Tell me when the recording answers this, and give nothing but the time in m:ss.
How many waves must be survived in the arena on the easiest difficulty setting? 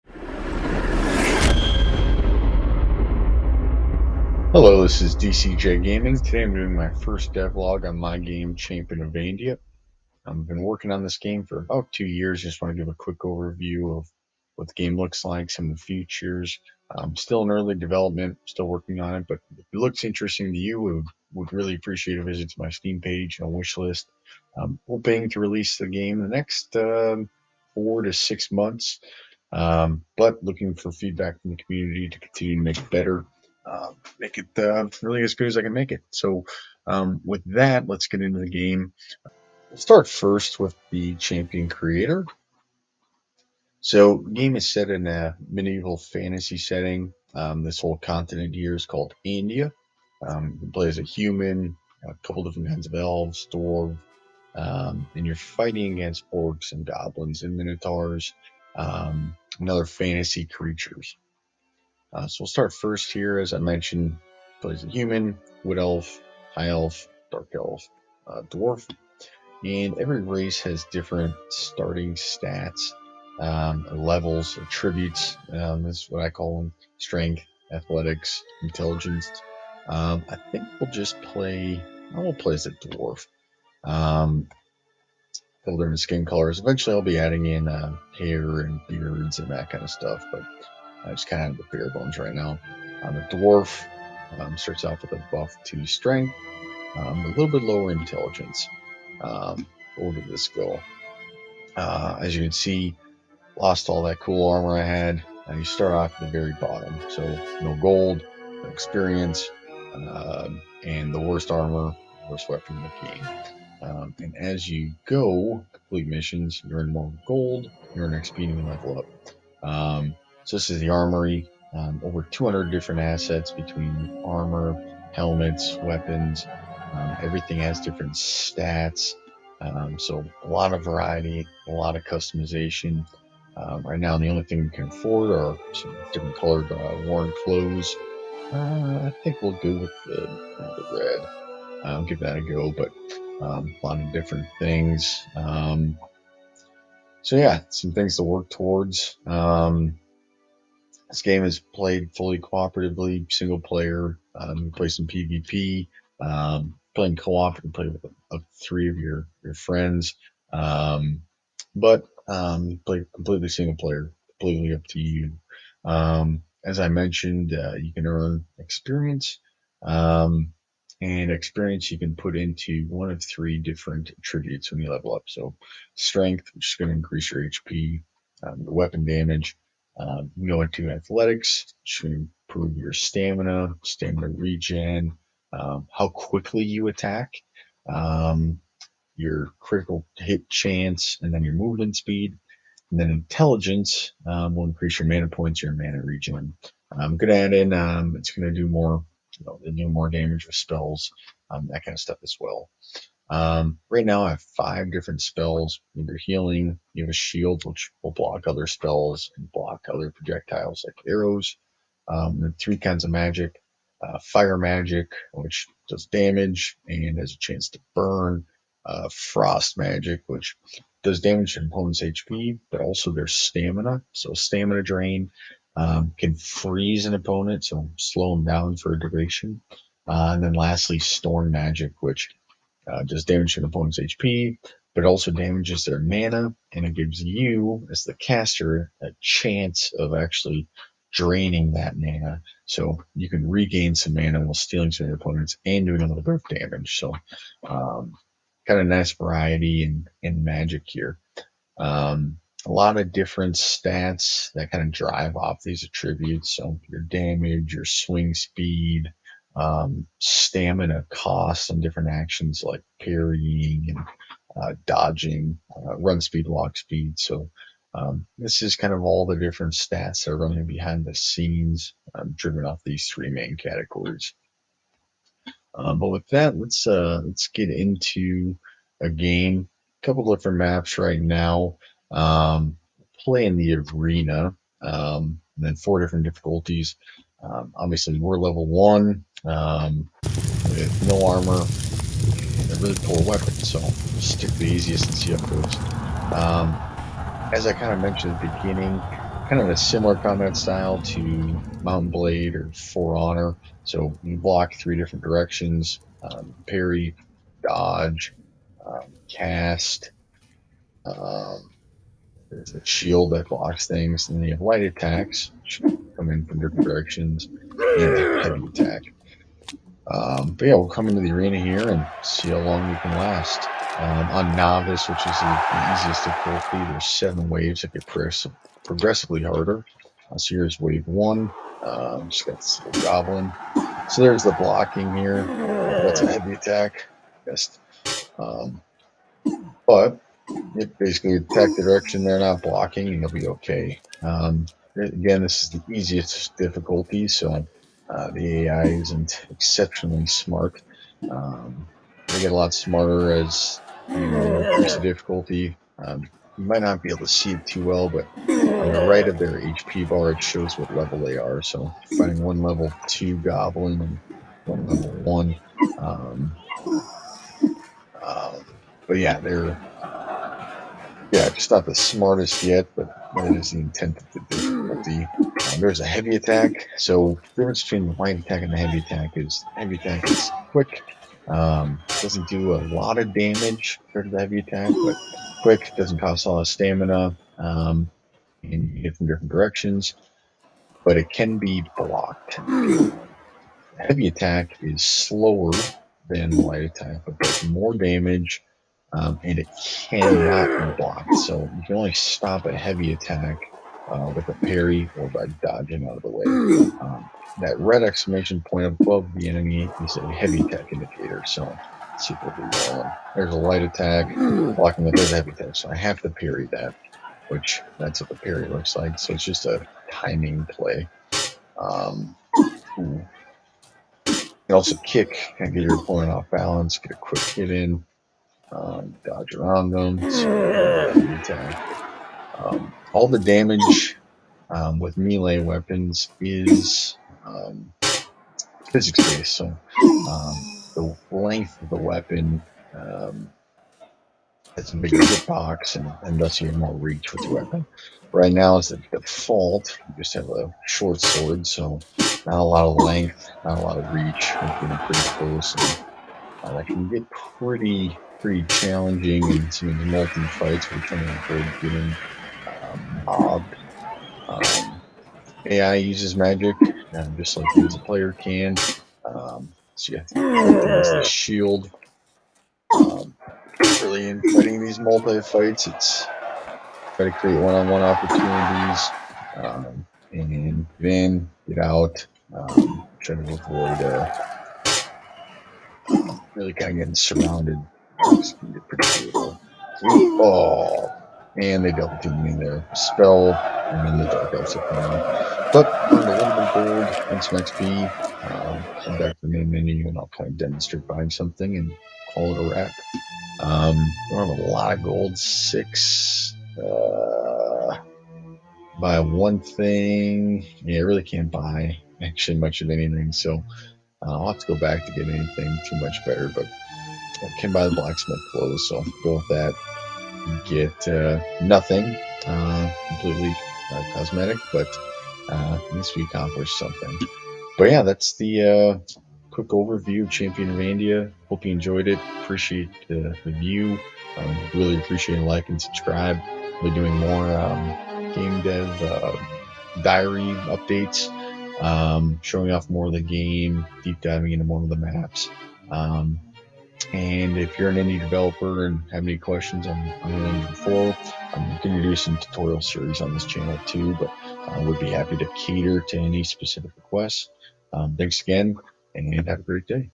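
5:27.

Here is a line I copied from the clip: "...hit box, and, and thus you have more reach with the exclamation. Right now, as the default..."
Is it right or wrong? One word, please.
wrong.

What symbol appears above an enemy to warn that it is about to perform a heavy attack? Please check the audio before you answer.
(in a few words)
Red exclamation point.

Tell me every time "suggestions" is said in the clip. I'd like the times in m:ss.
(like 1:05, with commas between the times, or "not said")
not said.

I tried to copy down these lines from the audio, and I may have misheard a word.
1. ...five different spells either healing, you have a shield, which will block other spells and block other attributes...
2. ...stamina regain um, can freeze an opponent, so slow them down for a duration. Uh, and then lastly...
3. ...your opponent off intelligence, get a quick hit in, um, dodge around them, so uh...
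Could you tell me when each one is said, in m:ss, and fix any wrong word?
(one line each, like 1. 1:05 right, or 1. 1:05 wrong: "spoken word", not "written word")
1. 3:24 wrong: "projectiles", not "attributes"
2. 3:44 wrong: "drain", not "regain"
3. 7:05 wrong: "balance", not "intelligence".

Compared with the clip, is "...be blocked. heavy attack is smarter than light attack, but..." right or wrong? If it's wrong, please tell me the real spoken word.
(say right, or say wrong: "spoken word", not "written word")
wrong: "slower", not "smarter".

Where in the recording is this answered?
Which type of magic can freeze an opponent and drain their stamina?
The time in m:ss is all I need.
3:39.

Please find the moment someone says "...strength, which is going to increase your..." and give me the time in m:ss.
2:55.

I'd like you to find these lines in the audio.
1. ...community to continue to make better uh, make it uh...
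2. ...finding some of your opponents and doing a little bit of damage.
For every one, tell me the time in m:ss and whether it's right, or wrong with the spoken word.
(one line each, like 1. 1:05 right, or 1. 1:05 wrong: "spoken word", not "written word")
1. 0:31 right
2. 4:04 wrong: "stealing", not "finding".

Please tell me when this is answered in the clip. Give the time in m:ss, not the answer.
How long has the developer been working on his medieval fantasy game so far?
0:11.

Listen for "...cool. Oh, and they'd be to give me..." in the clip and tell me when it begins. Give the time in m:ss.
8:09.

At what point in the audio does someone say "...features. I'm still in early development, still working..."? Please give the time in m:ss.
0:15.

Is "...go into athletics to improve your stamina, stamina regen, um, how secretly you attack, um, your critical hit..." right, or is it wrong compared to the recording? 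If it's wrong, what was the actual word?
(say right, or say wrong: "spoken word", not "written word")
wrong: "quickly", not "secretly".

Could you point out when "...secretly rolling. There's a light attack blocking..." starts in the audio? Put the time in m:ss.
6:52.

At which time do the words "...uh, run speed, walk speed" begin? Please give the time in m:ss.
4:25.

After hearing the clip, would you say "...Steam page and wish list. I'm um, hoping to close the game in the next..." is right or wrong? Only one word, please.
wrong.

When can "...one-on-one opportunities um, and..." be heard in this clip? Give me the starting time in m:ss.
7:57.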